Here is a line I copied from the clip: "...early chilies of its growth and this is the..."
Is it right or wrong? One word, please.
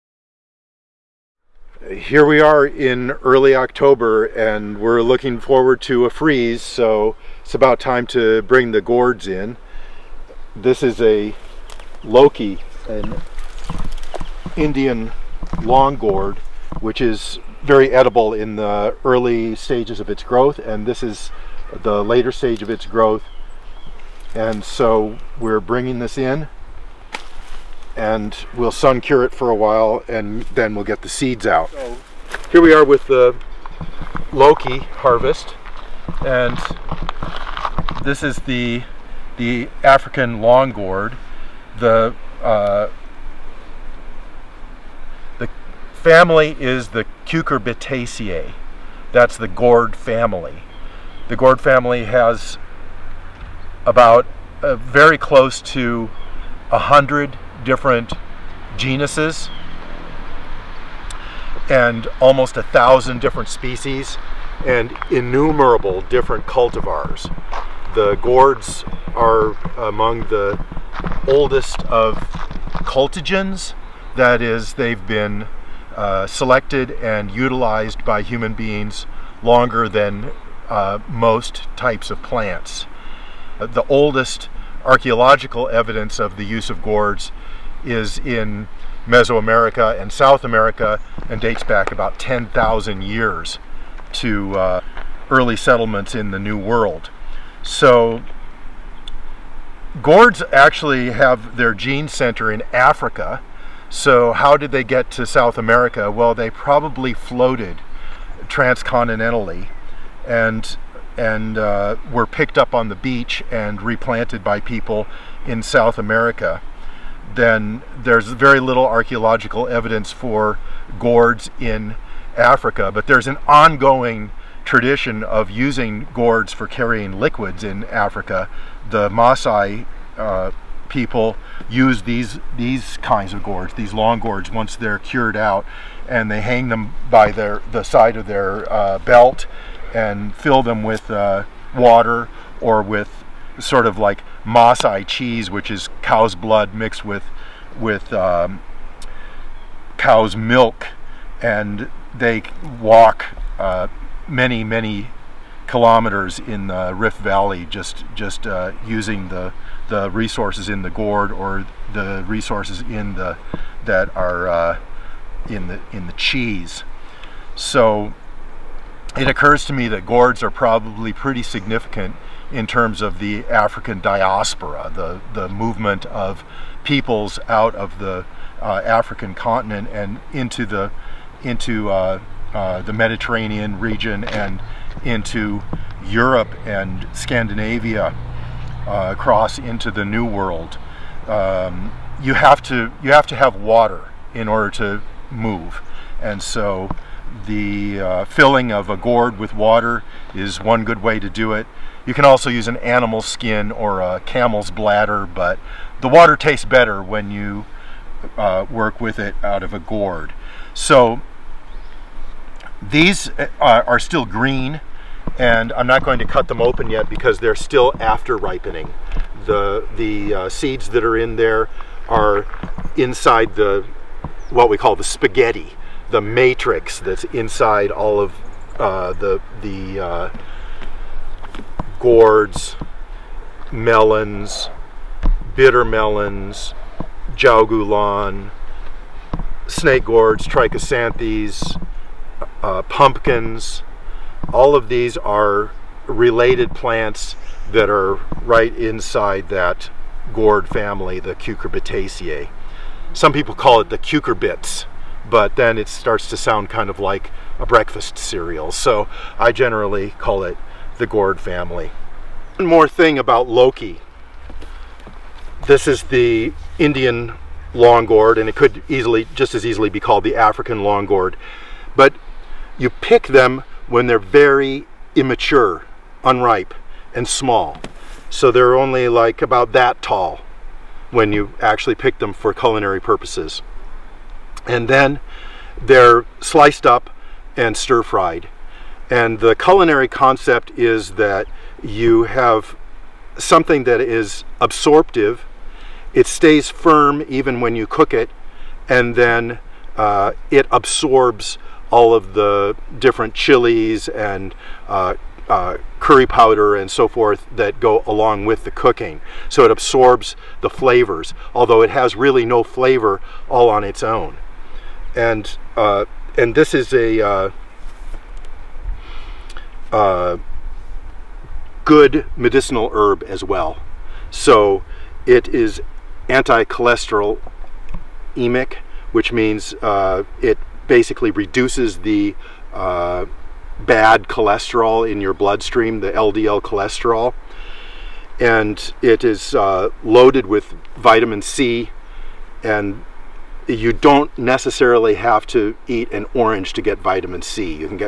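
wrong.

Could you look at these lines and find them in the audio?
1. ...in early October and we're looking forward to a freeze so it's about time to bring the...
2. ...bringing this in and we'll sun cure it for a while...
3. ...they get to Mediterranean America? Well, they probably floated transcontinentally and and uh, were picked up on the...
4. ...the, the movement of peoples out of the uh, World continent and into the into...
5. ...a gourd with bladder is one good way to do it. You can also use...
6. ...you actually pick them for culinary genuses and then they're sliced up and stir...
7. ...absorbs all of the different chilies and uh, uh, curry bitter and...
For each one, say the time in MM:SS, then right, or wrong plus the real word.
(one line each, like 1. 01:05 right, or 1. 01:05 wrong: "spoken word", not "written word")
1. 00:02 right
2. 00:25 right
3. 01:44 wrong: "South", not "Mediterranean"
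4. 02:54 wrong: "African", not "World"
5. 03:18 wrong: "water", not "bladder"
6. 04:41 wrong: "purposes", not "genuses"
7. 05:00 wrong: "powder", not "bitter".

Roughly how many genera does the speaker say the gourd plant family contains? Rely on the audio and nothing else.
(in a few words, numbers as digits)
close to 100.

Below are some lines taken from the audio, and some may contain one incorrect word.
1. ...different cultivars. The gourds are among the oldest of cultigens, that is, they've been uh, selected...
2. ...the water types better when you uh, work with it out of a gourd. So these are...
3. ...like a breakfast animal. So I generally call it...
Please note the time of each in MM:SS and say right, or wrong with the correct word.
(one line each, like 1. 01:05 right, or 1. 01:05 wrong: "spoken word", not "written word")
1. 01:06 right
2. 03:26 wrong: "tastes", not "types"
3. 04:16 wrong: "cereal", not "animal".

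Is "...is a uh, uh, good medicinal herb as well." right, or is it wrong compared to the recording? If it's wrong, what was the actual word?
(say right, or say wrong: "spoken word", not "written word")
right.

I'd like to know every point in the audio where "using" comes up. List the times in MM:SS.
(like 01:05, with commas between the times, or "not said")
02:05, 02:38.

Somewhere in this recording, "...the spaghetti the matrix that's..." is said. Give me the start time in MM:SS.
03:44.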